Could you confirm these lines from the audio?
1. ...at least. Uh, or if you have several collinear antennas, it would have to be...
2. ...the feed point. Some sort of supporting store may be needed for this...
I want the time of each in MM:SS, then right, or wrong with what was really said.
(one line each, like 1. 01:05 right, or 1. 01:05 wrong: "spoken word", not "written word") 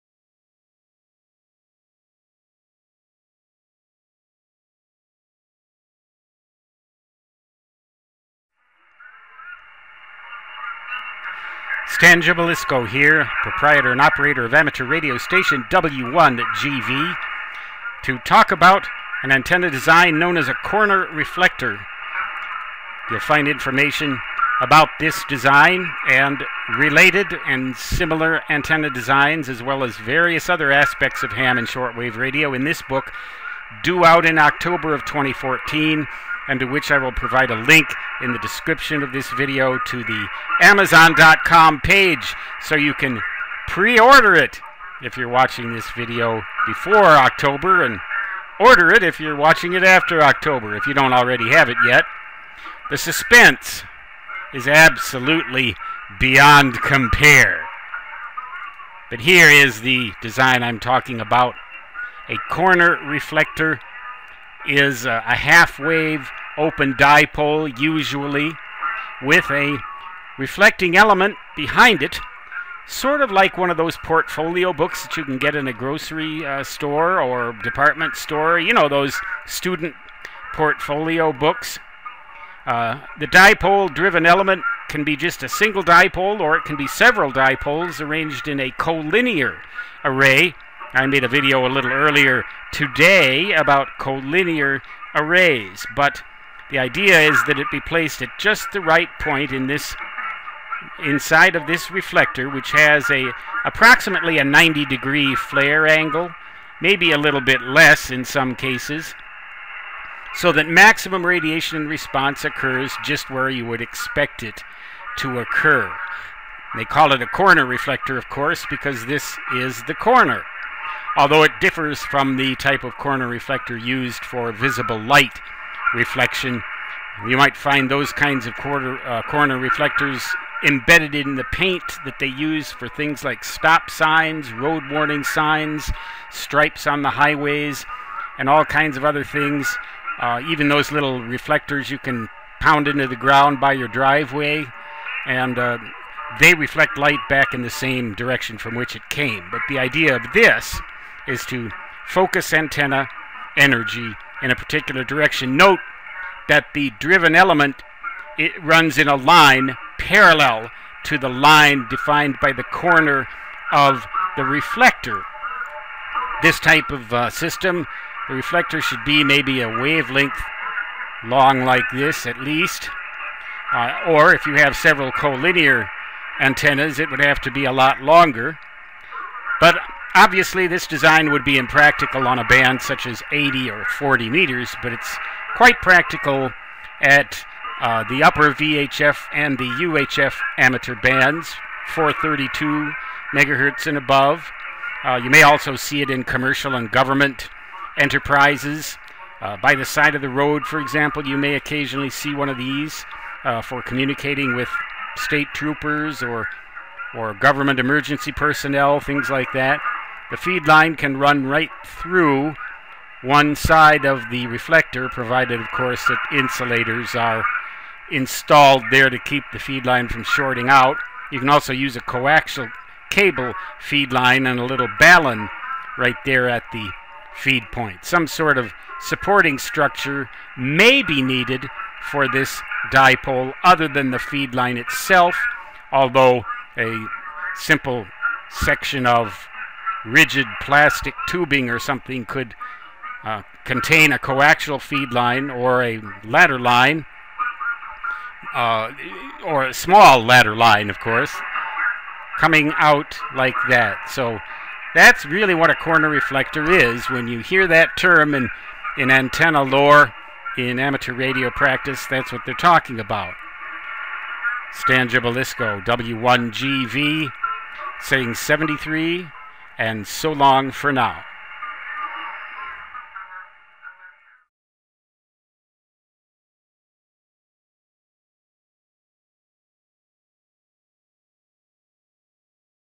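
1. 02:52 right
2. 03:46 wrong: "structure", not "store".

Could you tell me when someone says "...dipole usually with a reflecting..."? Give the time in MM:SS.
01:06.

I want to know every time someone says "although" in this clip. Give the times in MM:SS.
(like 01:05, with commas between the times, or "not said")
02:01, 03:55.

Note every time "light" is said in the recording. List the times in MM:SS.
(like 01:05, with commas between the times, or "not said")
02:04, 02:26.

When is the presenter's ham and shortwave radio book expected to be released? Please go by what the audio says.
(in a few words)
October 2014.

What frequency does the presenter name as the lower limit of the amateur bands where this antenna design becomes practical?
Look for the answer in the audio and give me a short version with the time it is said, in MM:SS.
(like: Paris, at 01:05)
432 MHz, at 03:11.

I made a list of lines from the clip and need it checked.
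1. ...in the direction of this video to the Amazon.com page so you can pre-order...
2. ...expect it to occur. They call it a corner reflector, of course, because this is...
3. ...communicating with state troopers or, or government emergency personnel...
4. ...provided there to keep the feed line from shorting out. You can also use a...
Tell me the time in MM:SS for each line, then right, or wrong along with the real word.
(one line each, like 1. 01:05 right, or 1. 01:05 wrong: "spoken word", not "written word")
1. 00:38 wrong: "description", not "direction"
2. 01:53 right
3. 03:23 right
4. 03:38 wrong: "installed", not "provided".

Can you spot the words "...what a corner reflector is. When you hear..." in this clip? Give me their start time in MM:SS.
04:15.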